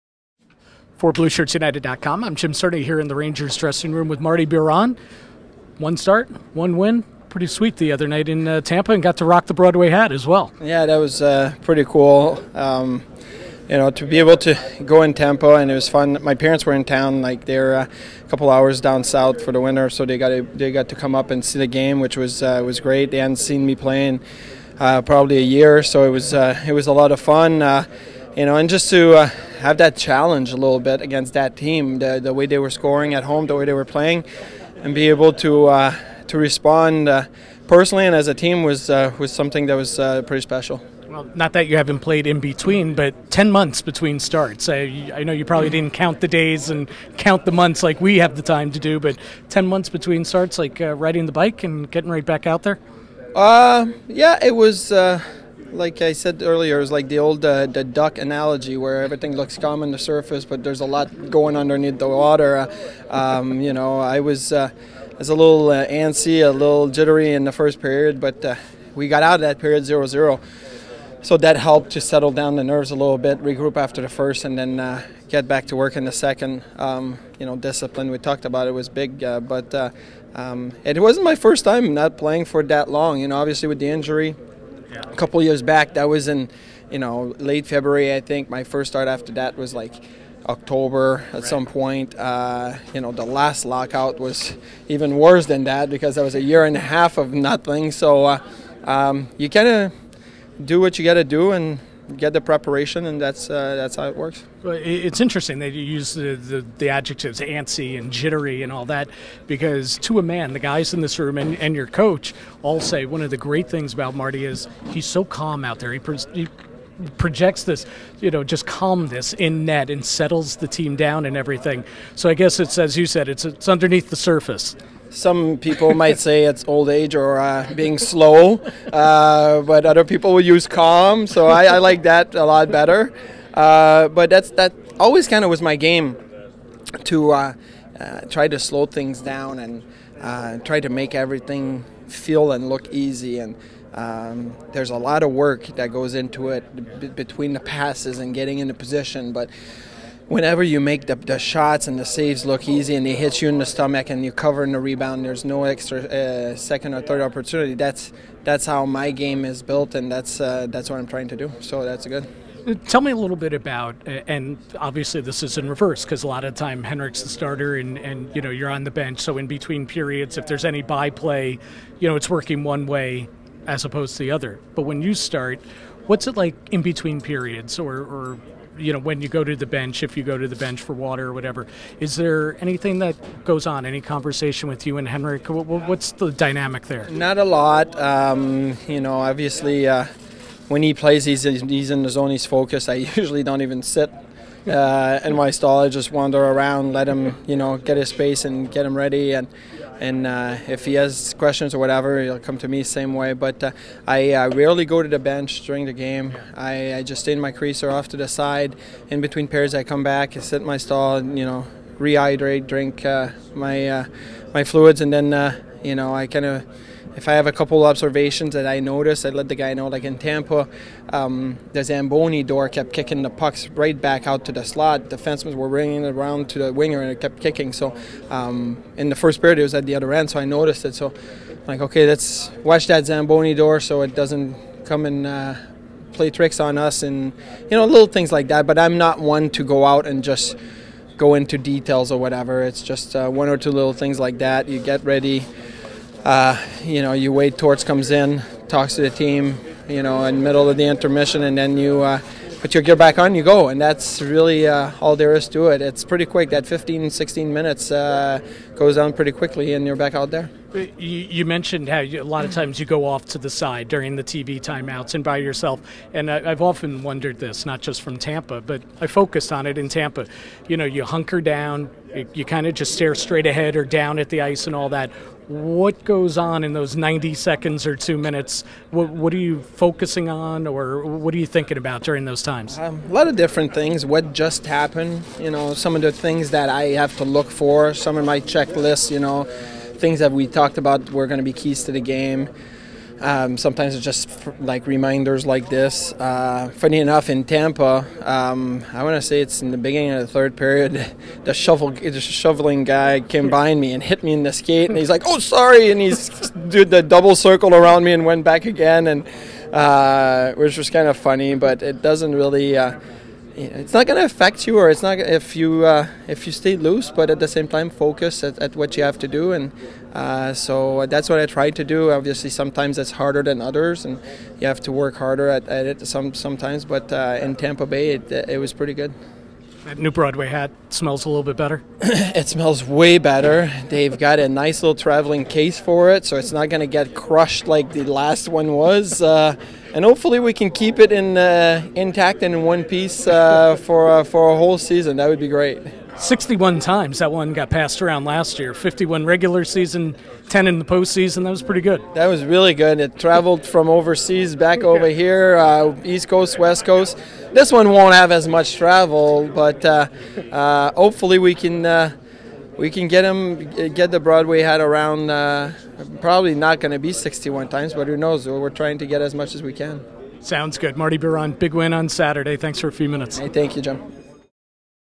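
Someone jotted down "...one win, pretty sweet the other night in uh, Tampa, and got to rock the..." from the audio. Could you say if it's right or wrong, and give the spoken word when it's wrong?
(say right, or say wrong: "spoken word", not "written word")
right.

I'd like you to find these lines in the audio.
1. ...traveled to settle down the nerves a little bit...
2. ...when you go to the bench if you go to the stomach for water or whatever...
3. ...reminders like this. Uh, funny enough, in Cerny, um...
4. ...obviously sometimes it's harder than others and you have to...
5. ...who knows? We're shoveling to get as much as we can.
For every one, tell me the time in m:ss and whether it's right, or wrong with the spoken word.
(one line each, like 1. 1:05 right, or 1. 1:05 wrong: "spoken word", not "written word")
1. 1:11 wrong: "helped", not "traveled"
2. 2:58 wrong: "bench", not "stomach"
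3. 4:54 wrong: "Tampa", not "Cerny"
4. 5:22 right
5. 6:08 wrong: "trying", not "shoveling".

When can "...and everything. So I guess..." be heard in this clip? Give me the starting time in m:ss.
2:01.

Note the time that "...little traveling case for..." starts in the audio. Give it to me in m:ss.
5:34.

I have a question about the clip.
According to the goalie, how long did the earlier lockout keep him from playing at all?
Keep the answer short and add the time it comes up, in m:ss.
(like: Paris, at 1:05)
a year and a half, at 1:36.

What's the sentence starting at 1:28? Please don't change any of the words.
My first start after that was like October at right.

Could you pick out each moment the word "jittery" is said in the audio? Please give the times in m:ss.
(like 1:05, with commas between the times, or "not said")
1:06, 1:48.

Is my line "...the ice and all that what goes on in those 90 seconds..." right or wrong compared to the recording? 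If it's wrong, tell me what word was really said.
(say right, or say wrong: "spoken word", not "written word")
right.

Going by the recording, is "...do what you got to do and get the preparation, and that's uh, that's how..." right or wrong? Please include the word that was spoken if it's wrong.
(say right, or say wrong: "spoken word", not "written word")
right.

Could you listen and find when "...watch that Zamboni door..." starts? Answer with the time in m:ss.
3:52.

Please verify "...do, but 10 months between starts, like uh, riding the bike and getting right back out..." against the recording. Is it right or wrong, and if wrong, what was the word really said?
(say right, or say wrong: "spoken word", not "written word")
right.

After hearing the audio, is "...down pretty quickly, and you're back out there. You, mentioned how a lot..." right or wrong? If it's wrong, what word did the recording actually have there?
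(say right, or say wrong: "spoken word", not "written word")
right.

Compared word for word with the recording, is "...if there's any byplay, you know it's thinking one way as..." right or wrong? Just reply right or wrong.
wrong.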